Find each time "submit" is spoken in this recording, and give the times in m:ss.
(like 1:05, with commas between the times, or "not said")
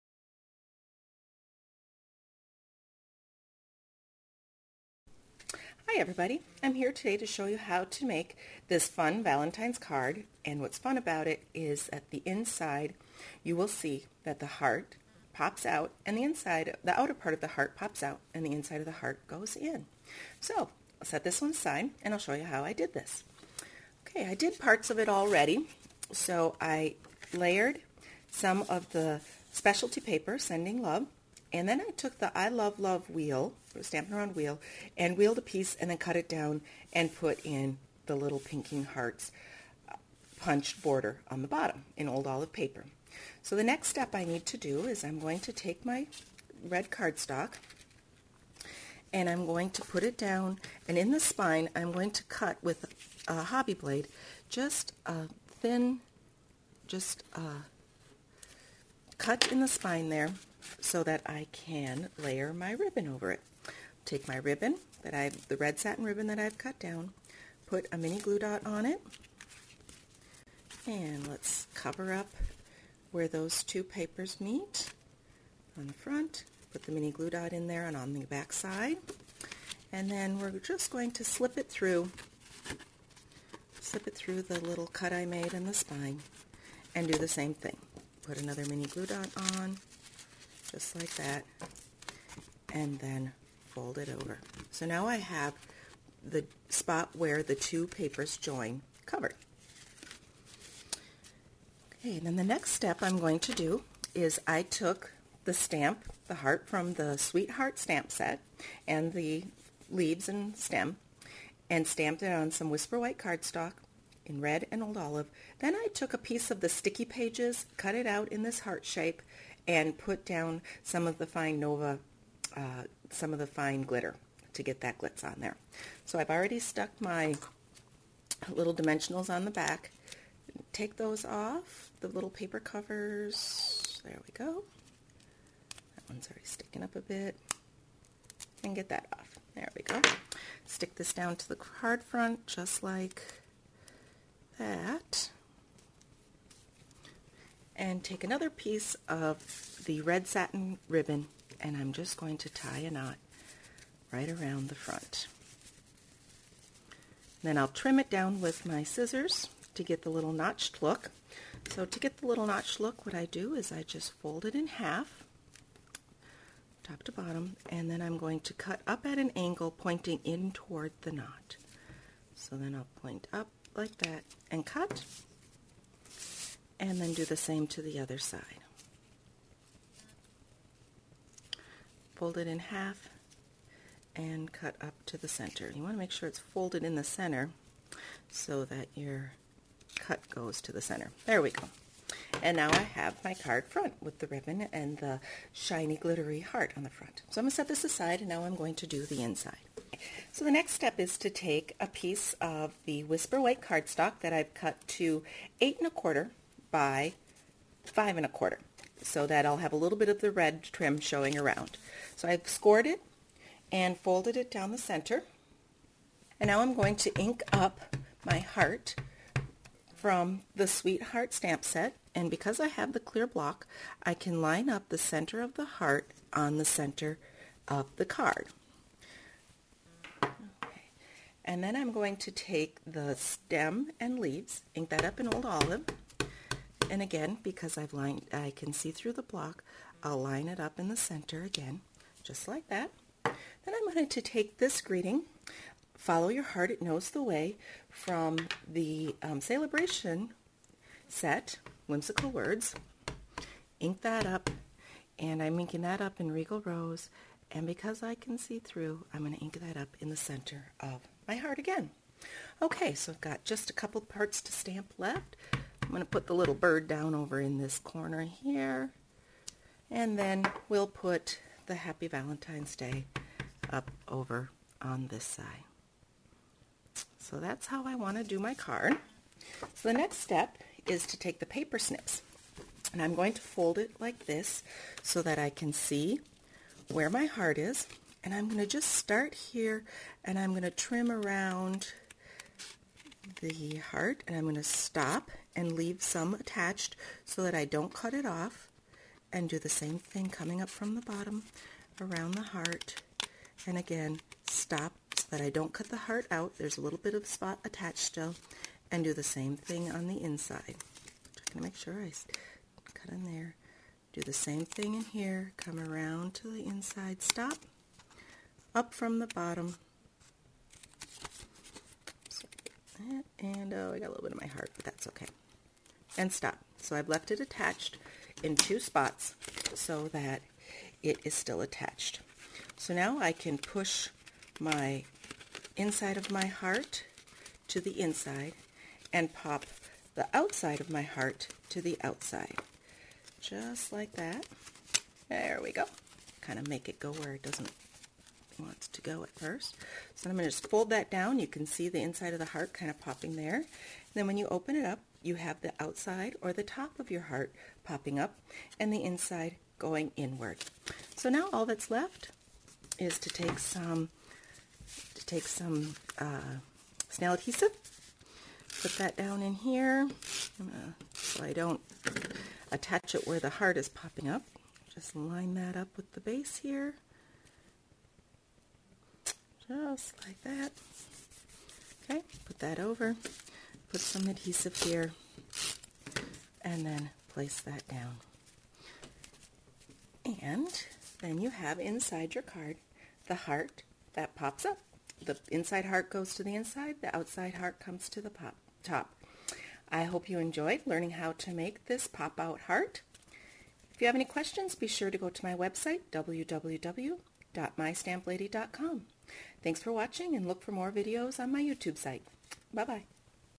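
not said.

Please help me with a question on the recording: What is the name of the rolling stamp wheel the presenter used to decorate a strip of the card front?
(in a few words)
I Love Love.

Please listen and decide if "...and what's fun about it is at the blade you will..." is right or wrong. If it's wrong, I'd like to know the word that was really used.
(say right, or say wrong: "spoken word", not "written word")
wrong: "inside", not "blade".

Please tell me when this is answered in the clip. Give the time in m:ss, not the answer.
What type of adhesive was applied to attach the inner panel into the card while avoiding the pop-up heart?
6:07.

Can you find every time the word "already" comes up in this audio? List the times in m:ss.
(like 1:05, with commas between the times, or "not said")
0:25, 2:06, 2:16.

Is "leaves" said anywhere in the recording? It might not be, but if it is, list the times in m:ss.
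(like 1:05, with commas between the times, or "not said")
1:49, 3:54, 4:55.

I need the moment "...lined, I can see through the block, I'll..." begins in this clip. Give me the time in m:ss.
3:57.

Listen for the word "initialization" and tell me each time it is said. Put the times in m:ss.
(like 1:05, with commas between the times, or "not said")
not said.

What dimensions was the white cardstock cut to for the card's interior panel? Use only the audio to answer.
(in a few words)
8 1/4 by 5 1/4.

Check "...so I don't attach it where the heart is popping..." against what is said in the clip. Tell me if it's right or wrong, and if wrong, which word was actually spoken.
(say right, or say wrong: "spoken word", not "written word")
right.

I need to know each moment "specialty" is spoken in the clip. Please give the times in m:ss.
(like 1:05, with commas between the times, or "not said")
0:29.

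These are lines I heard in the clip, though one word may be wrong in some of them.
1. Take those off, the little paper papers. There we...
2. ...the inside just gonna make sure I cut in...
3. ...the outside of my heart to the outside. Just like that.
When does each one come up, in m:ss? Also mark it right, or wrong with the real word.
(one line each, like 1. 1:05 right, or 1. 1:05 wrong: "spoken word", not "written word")
1. 2:10 wrong: "covers", not "papers"
2. 5:10 right
3. 5:40 right.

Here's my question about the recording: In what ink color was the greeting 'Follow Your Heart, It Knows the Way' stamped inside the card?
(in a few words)
Regal Rose.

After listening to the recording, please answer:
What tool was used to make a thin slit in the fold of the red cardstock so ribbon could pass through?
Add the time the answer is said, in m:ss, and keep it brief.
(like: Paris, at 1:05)
hobby blade, at 0:53.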